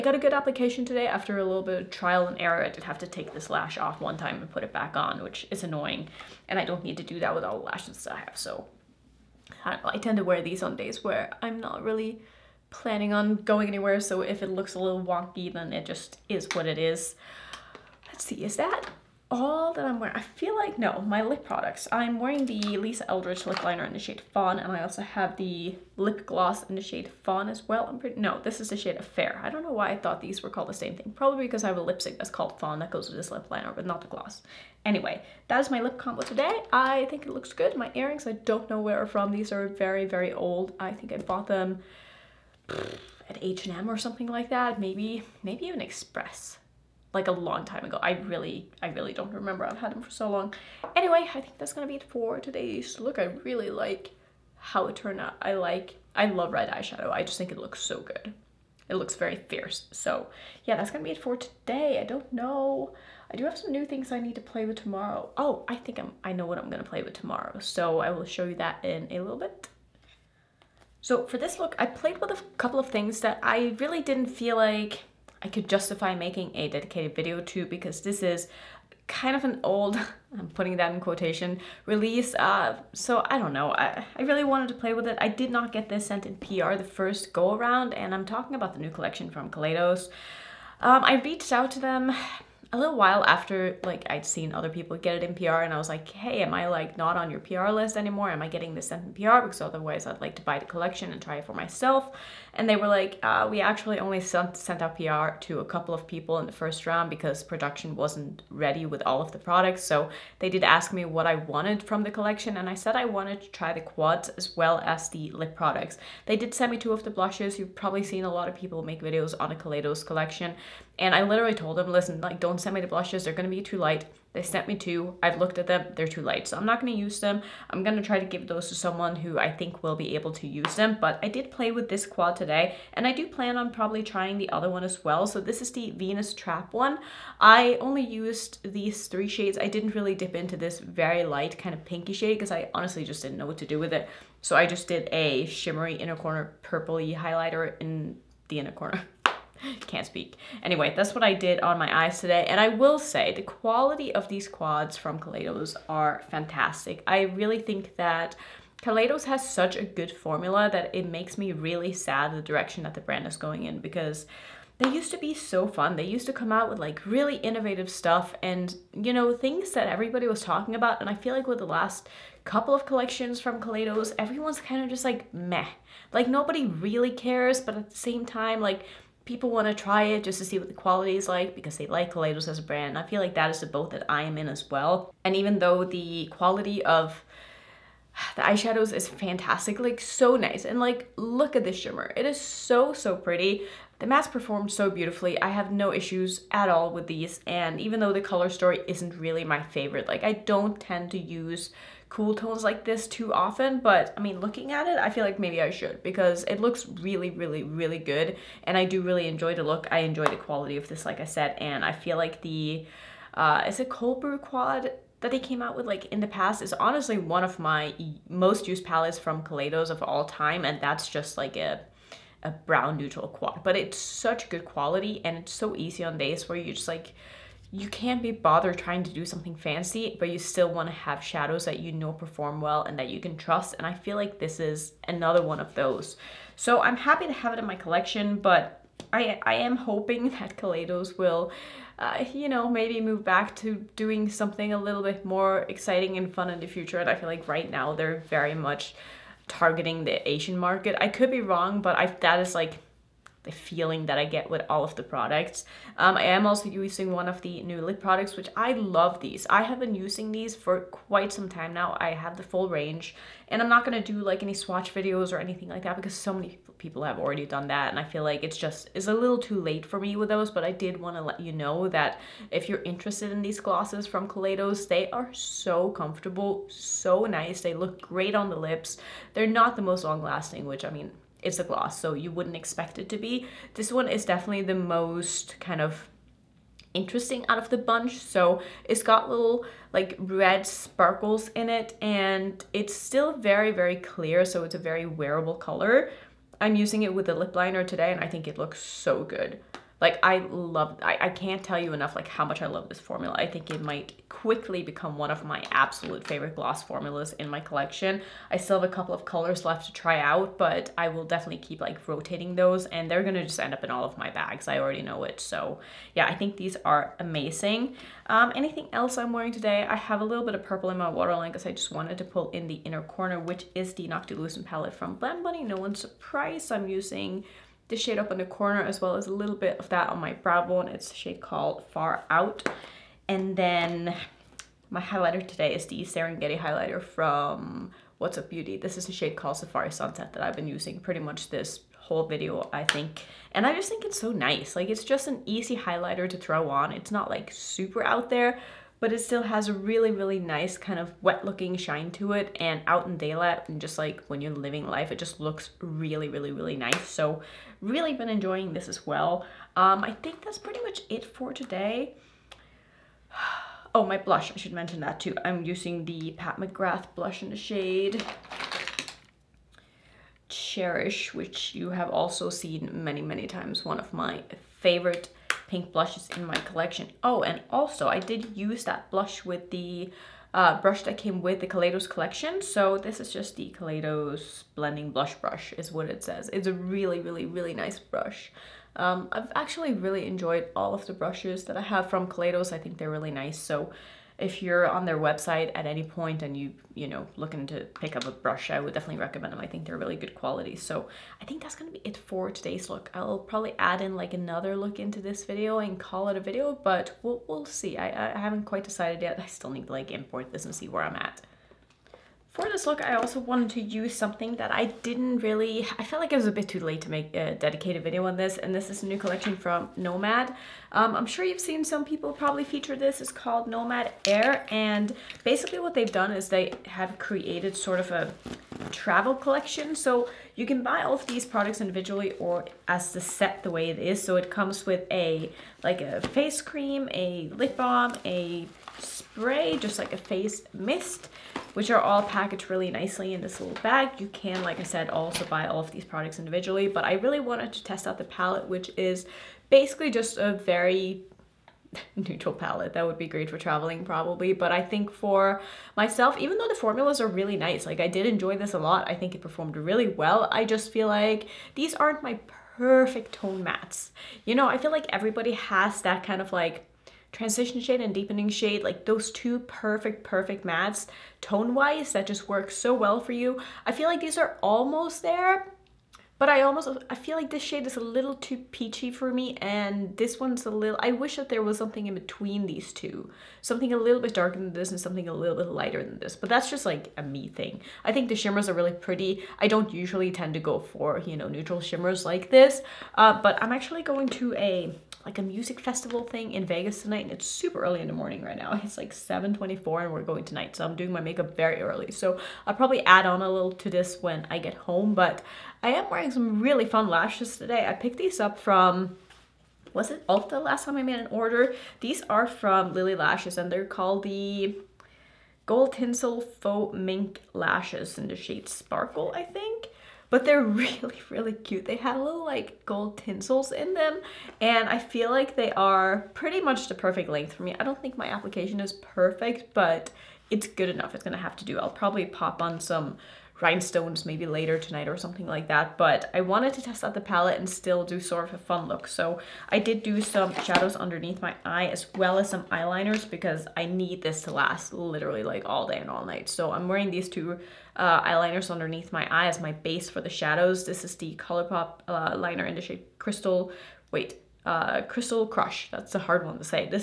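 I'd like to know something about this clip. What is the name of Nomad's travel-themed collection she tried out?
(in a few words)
Nomad Air.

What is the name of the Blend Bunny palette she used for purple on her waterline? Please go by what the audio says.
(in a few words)
Noctilucent.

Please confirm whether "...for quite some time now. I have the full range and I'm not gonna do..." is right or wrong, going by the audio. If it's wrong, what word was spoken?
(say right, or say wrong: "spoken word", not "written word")
right.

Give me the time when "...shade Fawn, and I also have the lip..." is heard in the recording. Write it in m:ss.
0:23.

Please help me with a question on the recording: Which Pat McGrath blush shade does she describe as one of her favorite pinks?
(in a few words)
Cherish.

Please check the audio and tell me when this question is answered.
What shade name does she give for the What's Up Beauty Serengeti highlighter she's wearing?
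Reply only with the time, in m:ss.
5:39.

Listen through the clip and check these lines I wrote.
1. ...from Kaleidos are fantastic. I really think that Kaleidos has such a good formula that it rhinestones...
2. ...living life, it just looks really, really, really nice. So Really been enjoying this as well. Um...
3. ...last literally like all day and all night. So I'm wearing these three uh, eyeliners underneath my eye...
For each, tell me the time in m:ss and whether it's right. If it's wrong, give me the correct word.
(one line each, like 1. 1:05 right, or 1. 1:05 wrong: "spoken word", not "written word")
1. 2:34 wrong: "makes", not "rhinestones"
2. 5:54 right
3. 9:04 wrong: "two", not "three".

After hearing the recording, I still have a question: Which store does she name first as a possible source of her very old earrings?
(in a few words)
H&M.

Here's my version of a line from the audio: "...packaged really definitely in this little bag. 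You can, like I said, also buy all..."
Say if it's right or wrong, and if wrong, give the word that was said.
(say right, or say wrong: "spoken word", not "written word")
wrong: "nicely", not "definitely".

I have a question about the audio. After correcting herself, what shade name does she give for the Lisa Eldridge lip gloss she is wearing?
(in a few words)
Fair.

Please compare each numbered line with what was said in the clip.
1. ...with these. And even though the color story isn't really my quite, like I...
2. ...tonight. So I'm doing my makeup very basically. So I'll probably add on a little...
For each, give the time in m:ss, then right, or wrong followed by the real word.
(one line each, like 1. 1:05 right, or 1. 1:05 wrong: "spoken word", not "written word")
1. 3:16 wrong: "favorite", not "quite"
2. 8:20 wrong: "early", not "basically".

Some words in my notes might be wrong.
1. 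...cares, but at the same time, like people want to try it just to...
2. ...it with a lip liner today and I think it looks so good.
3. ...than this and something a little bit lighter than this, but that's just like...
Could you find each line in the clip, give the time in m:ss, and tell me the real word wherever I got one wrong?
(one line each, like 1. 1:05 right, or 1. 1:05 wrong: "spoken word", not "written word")
1. 2:57 right
2. 4:57 right
3. 8:04 right.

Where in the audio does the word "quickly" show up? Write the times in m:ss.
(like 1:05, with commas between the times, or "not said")
5:04.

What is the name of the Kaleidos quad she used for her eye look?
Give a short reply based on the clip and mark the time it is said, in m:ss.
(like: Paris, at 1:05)
Venus Trap, at 2:15.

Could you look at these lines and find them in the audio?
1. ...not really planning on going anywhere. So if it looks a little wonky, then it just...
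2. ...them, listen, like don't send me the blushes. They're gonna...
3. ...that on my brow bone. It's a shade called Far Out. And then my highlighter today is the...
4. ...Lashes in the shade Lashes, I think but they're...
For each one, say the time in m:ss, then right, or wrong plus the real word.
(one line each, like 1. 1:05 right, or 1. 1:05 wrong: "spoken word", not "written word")
1. 0:11 right
2. 2:01 right
3. 5:29 right
4. 8:37 wrong: "Sparkle", not "Lashes".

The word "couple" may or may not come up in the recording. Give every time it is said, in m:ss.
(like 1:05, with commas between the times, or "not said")
1:12, 1:45, 2:52, 5:08.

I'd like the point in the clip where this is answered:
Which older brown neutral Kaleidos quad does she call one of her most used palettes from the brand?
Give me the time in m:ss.
3:33.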